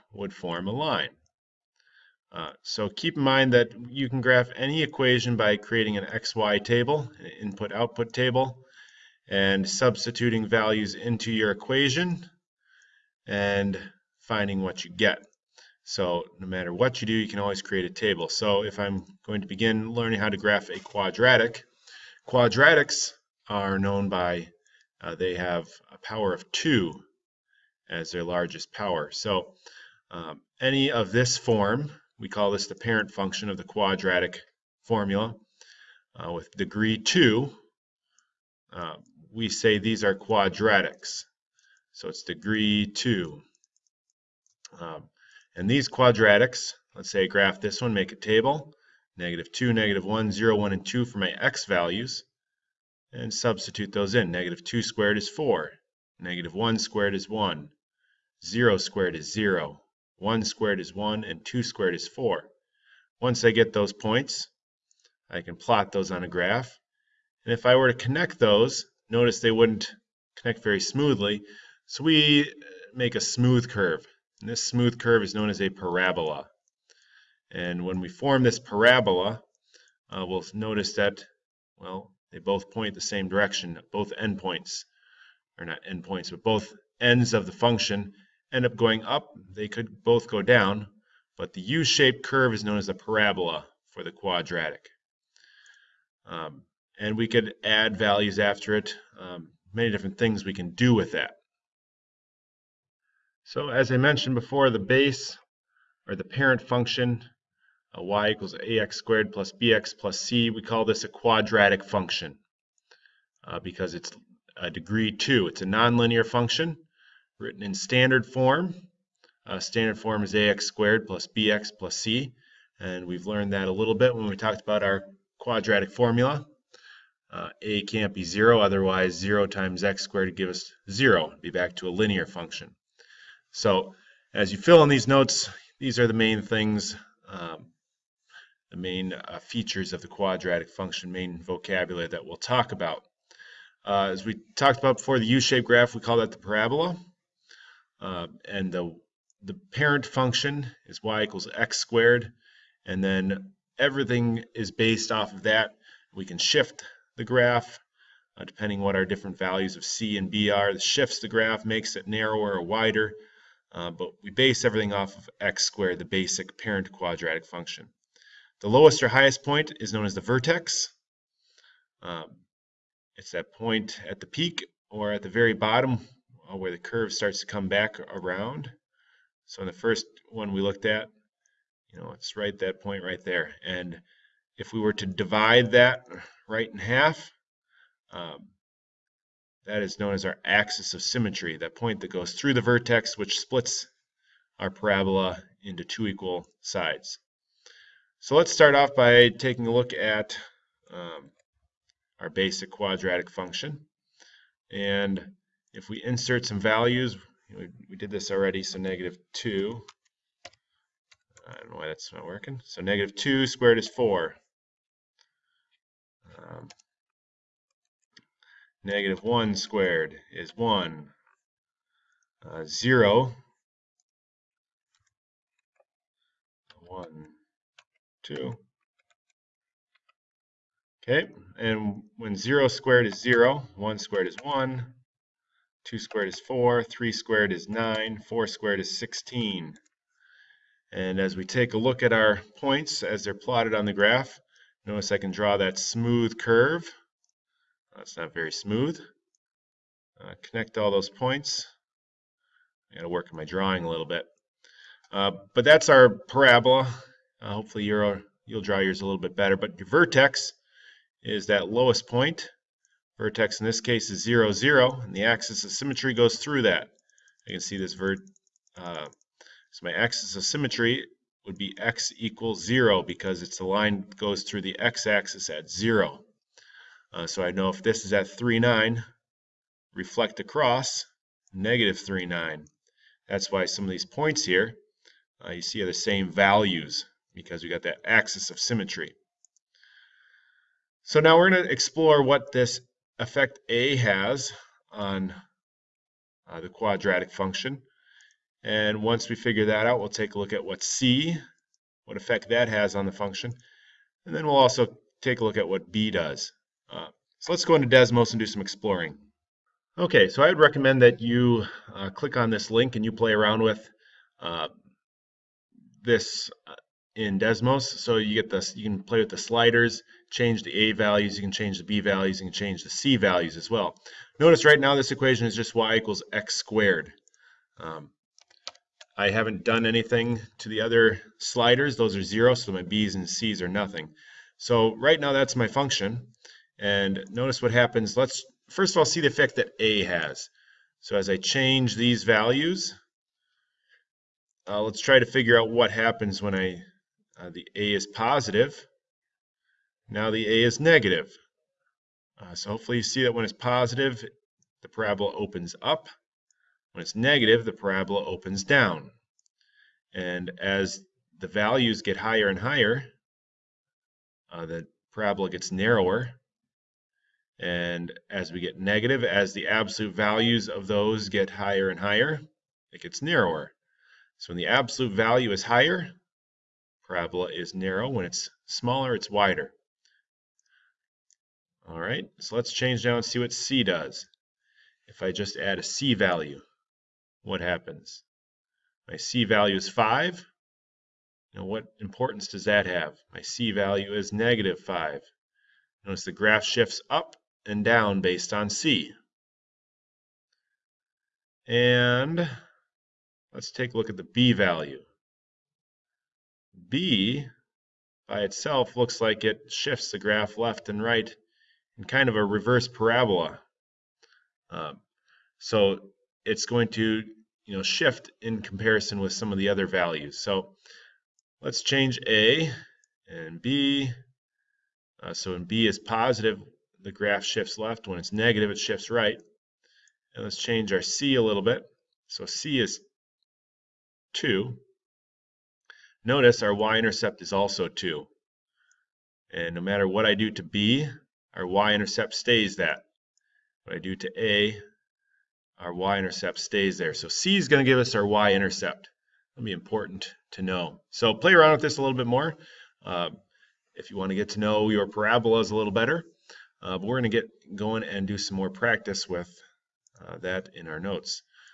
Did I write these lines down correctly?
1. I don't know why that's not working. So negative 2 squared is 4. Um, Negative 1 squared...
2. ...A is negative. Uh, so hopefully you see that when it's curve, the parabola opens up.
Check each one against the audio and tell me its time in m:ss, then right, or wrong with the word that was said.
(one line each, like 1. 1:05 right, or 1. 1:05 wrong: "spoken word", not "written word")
1. 3:31 right
2. 5:50 wrong: "positive", not "curve".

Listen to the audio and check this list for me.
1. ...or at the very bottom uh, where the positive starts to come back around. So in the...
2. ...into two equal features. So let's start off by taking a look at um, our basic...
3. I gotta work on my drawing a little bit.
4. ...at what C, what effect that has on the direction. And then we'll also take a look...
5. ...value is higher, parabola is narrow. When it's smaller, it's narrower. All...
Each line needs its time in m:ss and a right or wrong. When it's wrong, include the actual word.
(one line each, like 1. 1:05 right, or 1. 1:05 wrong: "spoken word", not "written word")
1. 2:54 wrong: "curve", not "positive"
2. 3:15 wrong: "sides", not "features"
3. 4:12 right
4. 5:00 wrong: "function", not "direction"
5. 6:15 wrong: "wider", not "narrower".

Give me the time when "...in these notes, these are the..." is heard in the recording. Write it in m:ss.
2:14.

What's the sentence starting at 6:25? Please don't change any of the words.
If I just add a C value, what happens?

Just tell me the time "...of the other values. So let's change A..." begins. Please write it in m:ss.
6:59.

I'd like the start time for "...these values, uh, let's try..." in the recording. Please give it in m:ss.
5:41.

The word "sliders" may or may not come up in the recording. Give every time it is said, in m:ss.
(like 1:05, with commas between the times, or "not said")
5:19, 5:31.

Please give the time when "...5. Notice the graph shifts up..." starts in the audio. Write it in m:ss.
6:34.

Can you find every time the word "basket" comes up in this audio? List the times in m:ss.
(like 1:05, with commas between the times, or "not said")
not said.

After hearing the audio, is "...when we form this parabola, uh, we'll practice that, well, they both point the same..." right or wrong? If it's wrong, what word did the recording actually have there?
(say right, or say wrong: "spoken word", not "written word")
wrong: "notice", not "practice".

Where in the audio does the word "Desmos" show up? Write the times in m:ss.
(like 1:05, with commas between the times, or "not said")
5:07, 5:17.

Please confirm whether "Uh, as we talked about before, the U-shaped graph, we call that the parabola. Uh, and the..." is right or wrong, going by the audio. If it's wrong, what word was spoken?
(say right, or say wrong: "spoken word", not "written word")
right.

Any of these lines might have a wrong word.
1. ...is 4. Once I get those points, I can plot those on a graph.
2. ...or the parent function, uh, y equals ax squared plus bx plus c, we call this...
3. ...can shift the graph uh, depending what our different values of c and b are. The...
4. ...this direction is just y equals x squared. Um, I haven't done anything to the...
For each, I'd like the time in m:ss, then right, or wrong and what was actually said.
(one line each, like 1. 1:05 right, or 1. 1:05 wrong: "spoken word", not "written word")
1. 1:01 right
2. 1:46 right
3. 2:36 right
4. 5:24 wrong: "equation", not "direction".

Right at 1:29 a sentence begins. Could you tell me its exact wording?
They could both go down, but the U-shaped curve is known as a parabola for the quadratic.